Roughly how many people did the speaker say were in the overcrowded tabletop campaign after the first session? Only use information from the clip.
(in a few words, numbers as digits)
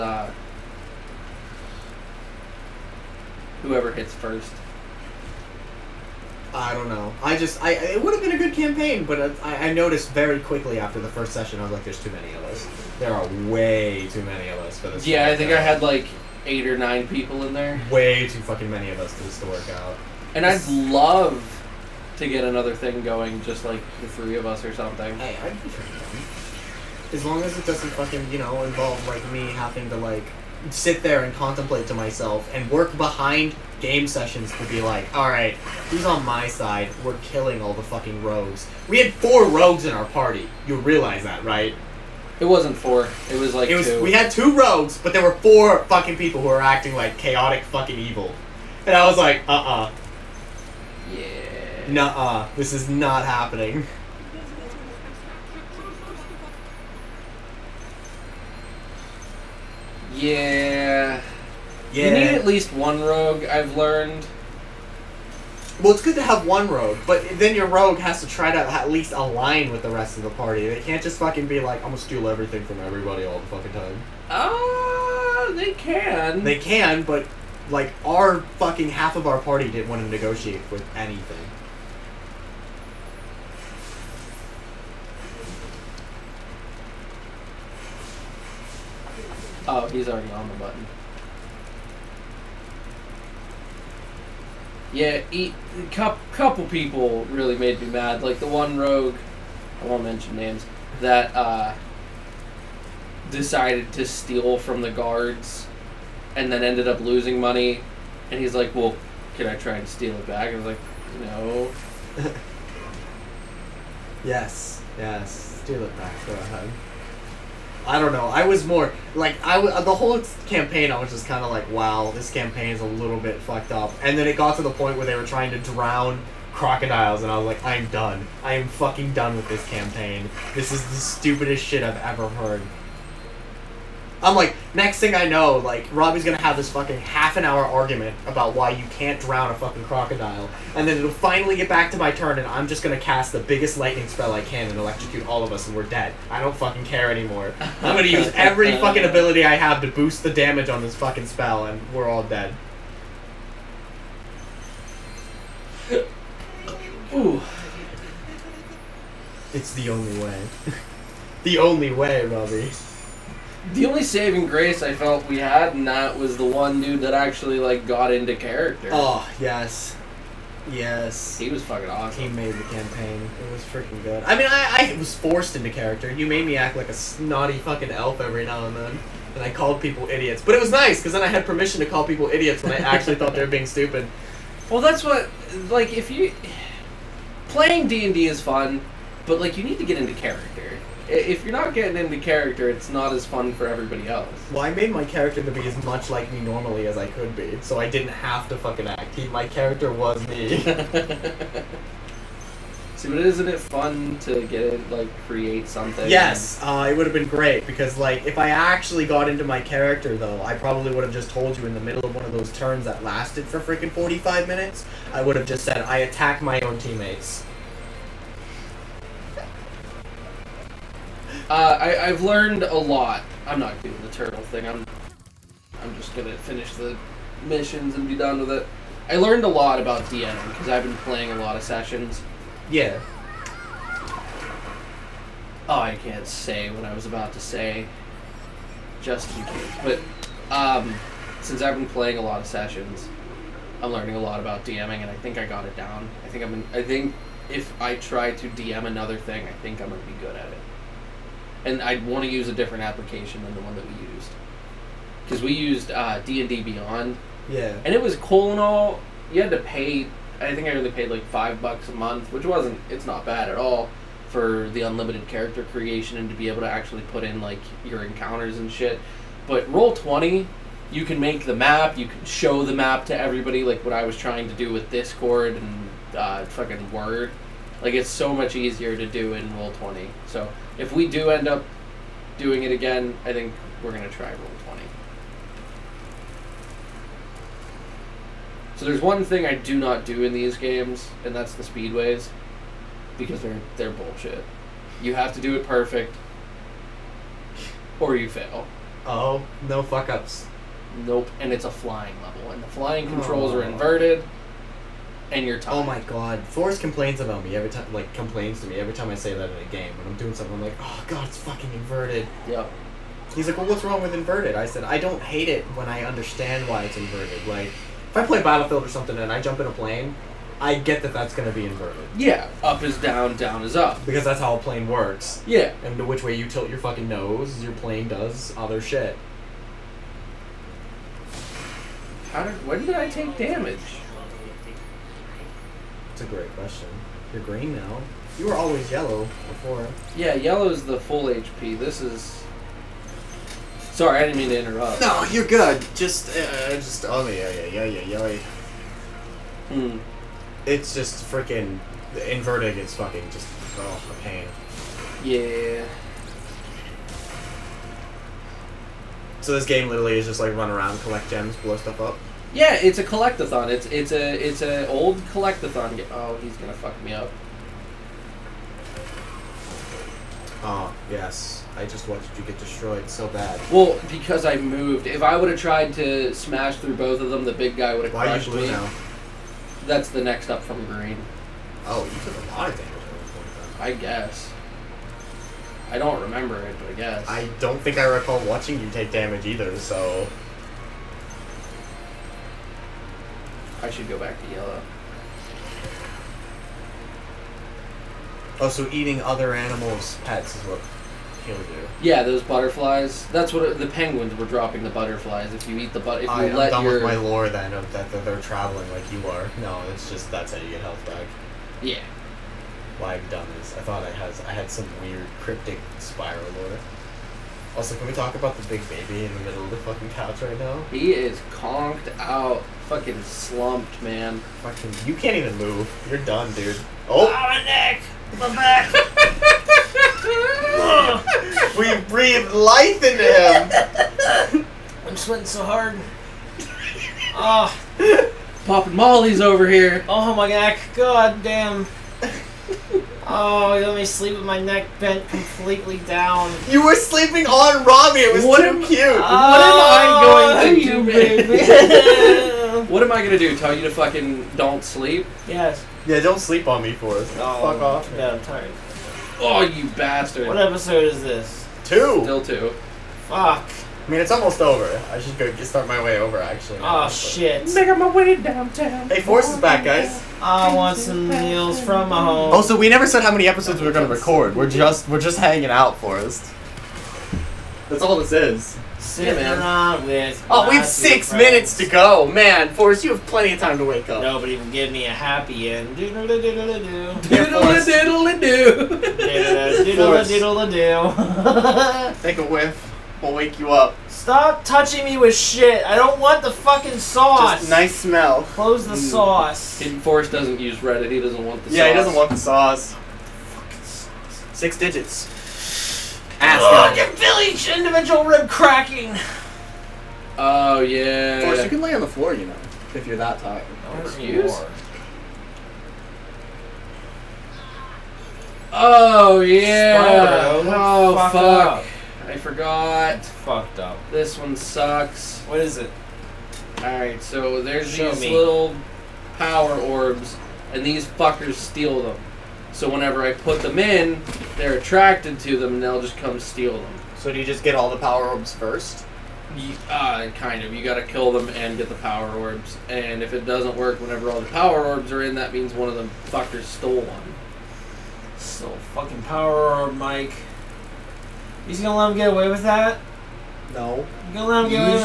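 8 or 9.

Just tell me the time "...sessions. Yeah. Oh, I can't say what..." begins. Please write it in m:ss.
3:51.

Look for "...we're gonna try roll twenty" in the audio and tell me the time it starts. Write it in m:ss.
4:43.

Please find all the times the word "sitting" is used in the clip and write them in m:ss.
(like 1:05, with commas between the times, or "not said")
7:59.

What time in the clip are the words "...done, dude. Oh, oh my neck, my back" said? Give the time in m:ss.
7:06.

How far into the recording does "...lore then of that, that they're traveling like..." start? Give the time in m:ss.
6:47.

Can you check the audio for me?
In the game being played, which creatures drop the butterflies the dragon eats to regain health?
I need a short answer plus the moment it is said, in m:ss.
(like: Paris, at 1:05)
Penguins, at 6:43.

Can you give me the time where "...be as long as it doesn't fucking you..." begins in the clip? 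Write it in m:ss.
0:25.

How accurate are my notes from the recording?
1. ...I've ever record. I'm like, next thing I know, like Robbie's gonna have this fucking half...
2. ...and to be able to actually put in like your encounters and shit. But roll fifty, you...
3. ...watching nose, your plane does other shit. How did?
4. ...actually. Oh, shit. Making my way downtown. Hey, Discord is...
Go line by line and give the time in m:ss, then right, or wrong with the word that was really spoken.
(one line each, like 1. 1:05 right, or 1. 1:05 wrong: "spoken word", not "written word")
1. 2:11 wrong: "heard", not "record"
2. 4:26 wrong: "twenty", not "fifty"
3. 5:26 wrong: "fucking", not "watching"
4. 7:46 wrong: "Force", not "Discord".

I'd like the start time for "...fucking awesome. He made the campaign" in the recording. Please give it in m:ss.
2:51.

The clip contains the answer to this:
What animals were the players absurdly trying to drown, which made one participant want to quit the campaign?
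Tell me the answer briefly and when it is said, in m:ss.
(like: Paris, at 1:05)
Crocodiles, at 2:06.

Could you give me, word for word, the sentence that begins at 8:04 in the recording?
Nobody can give me a happy end.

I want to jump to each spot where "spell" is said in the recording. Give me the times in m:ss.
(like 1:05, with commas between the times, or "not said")
2:24, 2:31.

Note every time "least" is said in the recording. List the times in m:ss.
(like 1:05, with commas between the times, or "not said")
1:02, 1:08.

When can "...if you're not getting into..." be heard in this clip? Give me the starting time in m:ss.
3:11.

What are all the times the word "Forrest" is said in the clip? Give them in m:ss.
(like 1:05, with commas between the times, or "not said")
5:06, 7:36, 7:55, 8:02, 8:20.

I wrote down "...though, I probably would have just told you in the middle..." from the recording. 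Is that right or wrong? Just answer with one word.
right.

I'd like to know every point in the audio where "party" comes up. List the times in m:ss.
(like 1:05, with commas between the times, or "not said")
0:40, 1:10, 1:19.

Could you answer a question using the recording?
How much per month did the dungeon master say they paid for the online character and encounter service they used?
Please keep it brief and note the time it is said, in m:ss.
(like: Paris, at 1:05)
5 dollars, at 4:21.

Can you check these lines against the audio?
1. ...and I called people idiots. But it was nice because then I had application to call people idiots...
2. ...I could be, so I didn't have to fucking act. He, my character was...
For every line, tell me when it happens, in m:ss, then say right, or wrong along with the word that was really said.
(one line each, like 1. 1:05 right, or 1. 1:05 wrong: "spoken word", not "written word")
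1. 2:59 wrong: "permission", not "application"
2. 3:16 right.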